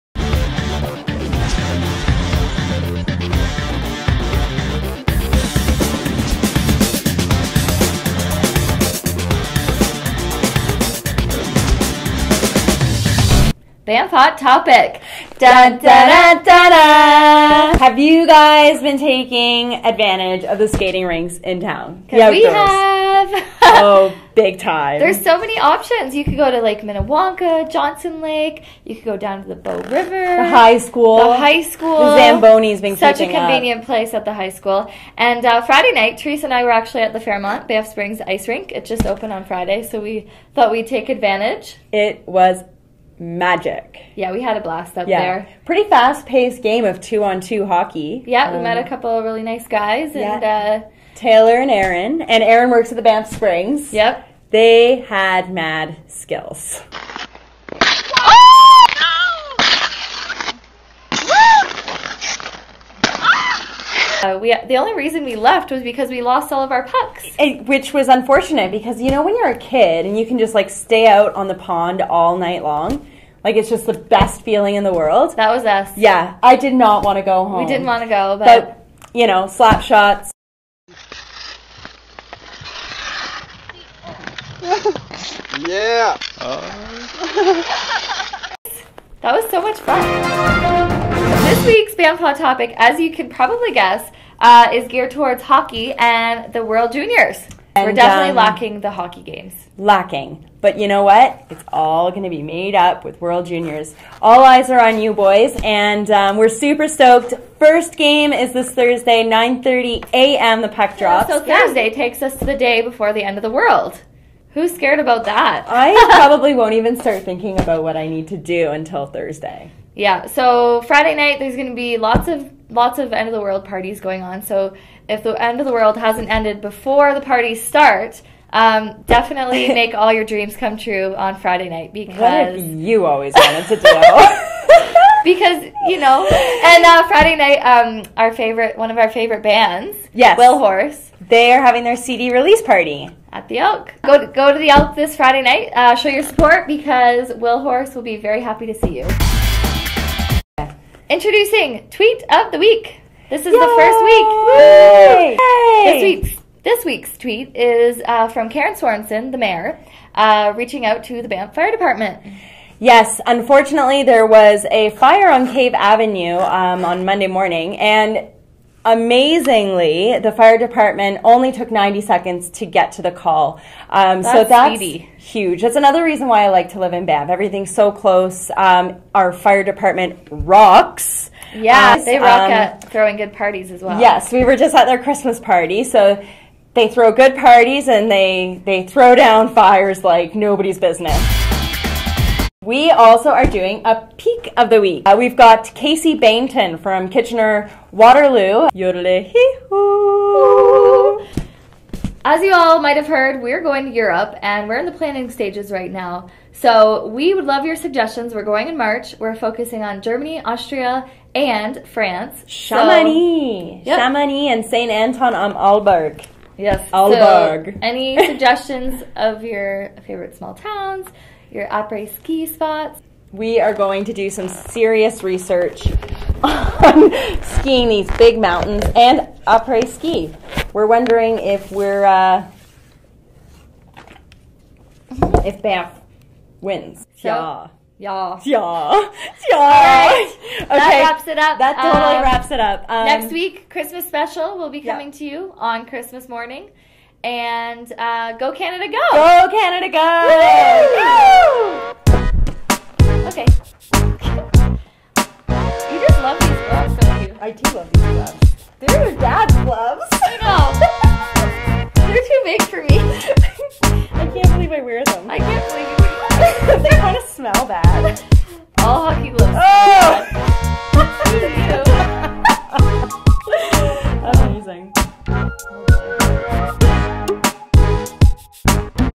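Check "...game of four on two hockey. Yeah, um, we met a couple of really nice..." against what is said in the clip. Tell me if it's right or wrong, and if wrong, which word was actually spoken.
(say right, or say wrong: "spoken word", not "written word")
wrong: "two", not "four".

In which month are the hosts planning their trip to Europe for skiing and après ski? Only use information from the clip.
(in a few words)
March.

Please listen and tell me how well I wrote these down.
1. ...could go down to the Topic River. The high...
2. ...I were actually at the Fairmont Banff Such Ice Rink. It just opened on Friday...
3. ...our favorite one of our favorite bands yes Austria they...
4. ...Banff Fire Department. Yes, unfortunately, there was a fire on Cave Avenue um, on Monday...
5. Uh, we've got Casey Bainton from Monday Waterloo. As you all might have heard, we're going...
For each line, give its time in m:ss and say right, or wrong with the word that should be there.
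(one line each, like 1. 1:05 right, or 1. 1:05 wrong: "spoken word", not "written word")
1. 0:28 wrong: "Bow", not "Topic"
2. 0:36 wrong: "Springs", not "Such"
3. 2:18 wrong: "Willhorse", not "Austria"
4. 2:41 right
5. 3:15 wrong: "Kitchener", not "Monday".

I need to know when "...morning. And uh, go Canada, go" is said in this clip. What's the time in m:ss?
4:06.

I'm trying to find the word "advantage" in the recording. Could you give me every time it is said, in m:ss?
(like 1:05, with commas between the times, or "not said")
0:19, 0:41.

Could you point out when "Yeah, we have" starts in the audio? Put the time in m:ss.
0:22.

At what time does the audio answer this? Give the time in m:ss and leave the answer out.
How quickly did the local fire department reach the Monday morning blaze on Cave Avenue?
2:51.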